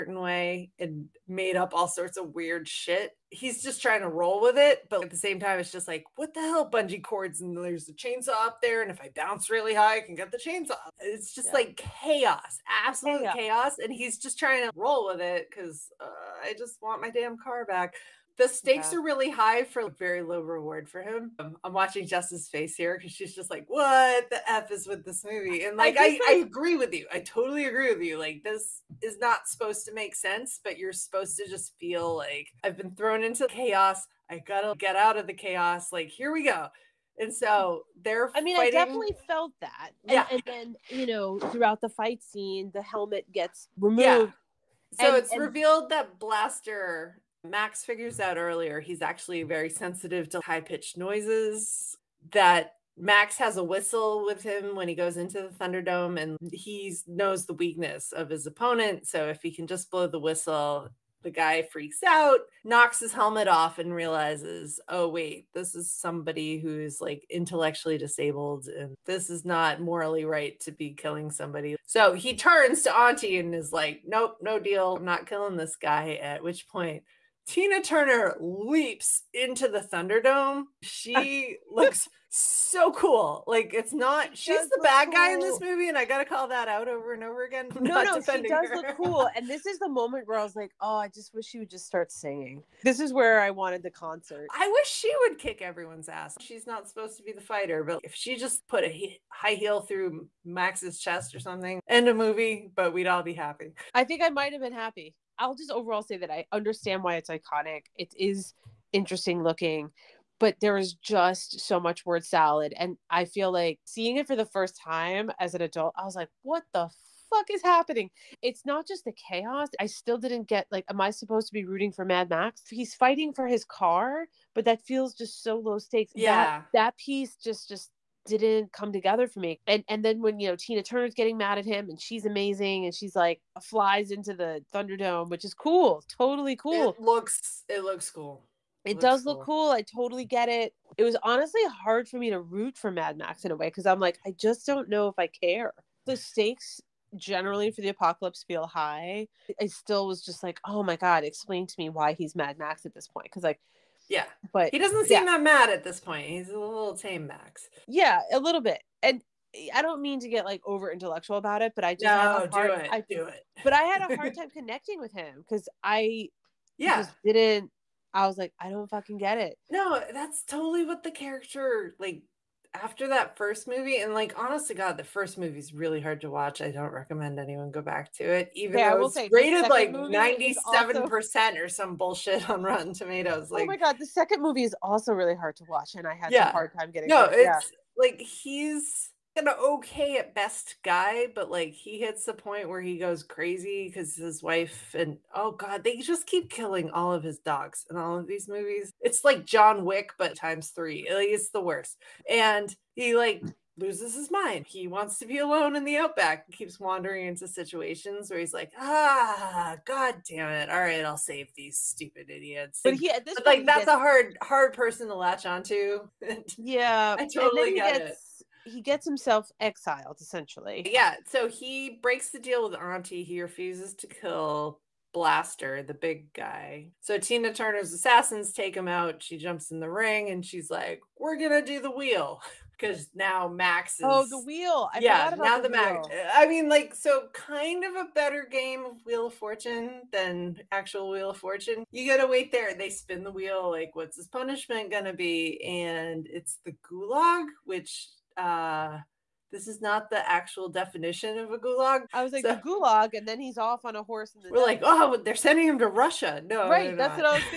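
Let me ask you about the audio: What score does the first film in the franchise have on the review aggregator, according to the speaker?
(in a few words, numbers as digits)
97 percent.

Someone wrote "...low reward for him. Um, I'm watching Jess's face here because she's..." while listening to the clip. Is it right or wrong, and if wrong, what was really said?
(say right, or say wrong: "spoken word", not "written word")
right.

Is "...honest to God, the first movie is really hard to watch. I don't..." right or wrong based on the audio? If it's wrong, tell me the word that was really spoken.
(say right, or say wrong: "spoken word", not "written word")
right.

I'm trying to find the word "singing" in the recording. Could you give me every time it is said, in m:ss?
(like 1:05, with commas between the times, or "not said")
1:32.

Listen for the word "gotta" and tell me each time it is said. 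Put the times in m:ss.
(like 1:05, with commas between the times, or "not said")
0:34, 1:26, 4:02.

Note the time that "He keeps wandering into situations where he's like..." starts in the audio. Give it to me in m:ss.
3:26.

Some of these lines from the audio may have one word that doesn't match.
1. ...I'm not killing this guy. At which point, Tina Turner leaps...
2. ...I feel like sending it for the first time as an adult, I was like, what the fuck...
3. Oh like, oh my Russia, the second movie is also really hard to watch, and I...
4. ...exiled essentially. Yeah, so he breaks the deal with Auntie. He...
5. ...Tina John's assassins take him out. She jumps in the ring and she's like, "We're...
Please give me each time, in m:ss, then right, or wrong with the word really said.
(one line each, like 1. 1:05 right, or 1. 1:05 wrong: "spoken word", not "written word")
1. 1:14 right
2. 1:53 wrong: "seeing", not "sending"
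3. 3:03 wrong: "God", not "Russia"
4. 3:39 right
5. 3:47 wrong: "Turner", not "John".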